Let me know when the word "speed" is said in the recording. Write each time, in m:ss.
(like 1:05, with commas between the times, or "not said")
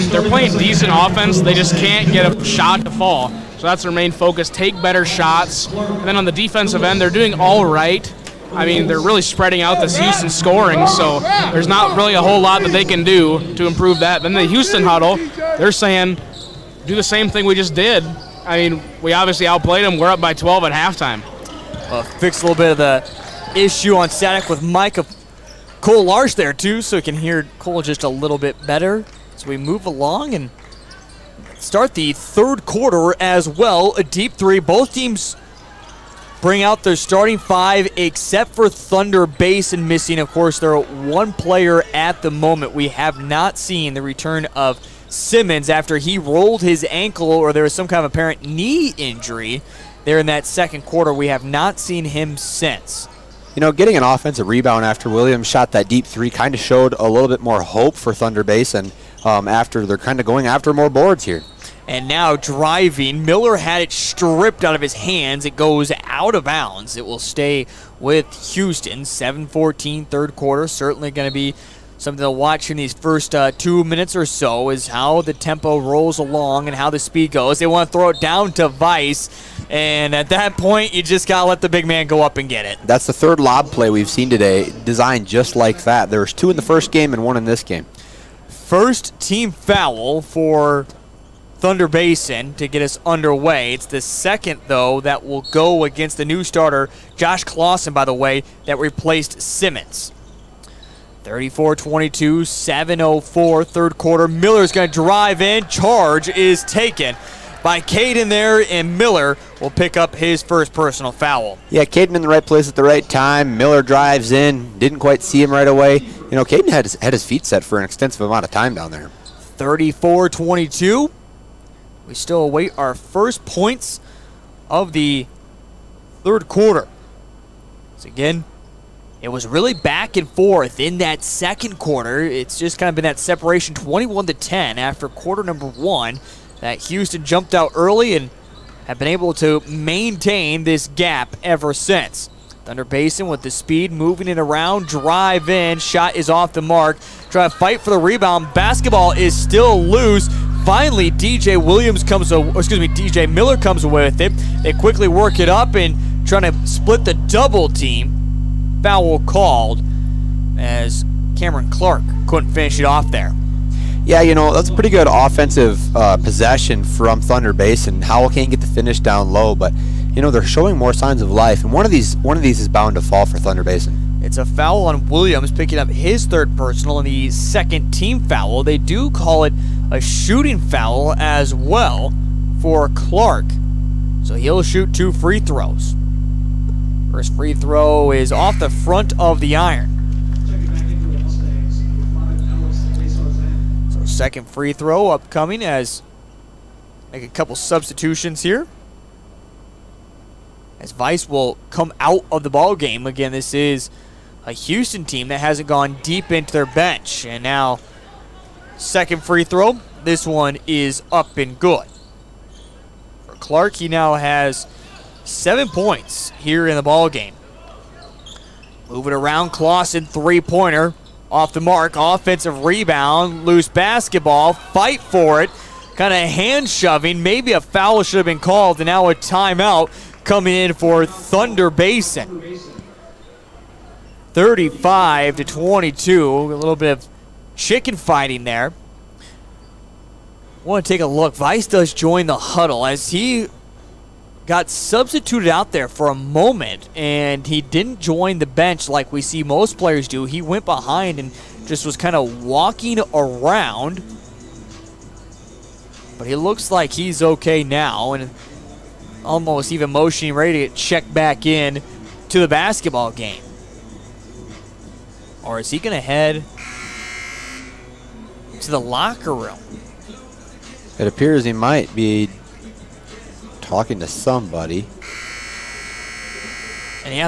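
1:16, 2:23.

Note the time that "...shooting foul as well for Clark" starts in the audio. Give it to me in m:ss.
2:59.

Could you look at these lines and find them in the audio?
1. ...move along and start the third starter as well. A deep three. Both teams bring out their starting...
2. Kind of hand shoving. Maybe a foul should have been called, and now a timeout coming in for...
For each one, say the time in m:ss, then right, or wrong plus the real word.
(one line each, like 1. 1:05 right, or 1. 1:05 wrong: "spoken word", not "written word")
1. 0:29 wrong: "quarter", not "starter"
2. 3:45 right.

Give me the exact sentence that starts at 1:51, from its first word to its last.
Yeah, Caden in the right place at the right time.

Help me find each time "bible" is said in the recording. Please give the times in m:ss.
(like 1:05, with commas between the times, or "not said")
not said.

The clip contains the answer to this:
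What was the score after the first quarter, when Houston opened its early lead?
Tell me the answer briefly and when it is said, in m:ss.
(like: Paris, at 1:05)
21 to 10, at 2:13.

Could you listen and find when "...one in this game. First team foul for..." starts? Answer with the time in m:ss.
1:27.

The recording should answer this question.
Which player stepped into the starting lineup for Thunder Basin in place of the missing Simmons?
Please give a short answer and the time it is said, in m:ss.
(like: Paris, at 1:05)
Josh Clausen, at 1:37.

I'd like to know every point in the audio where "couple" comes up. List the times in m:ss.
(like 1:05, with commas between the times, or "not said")
3:17.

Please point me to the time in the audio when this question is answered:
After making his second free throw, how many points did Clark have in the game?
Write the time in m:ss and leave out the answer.
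3:35.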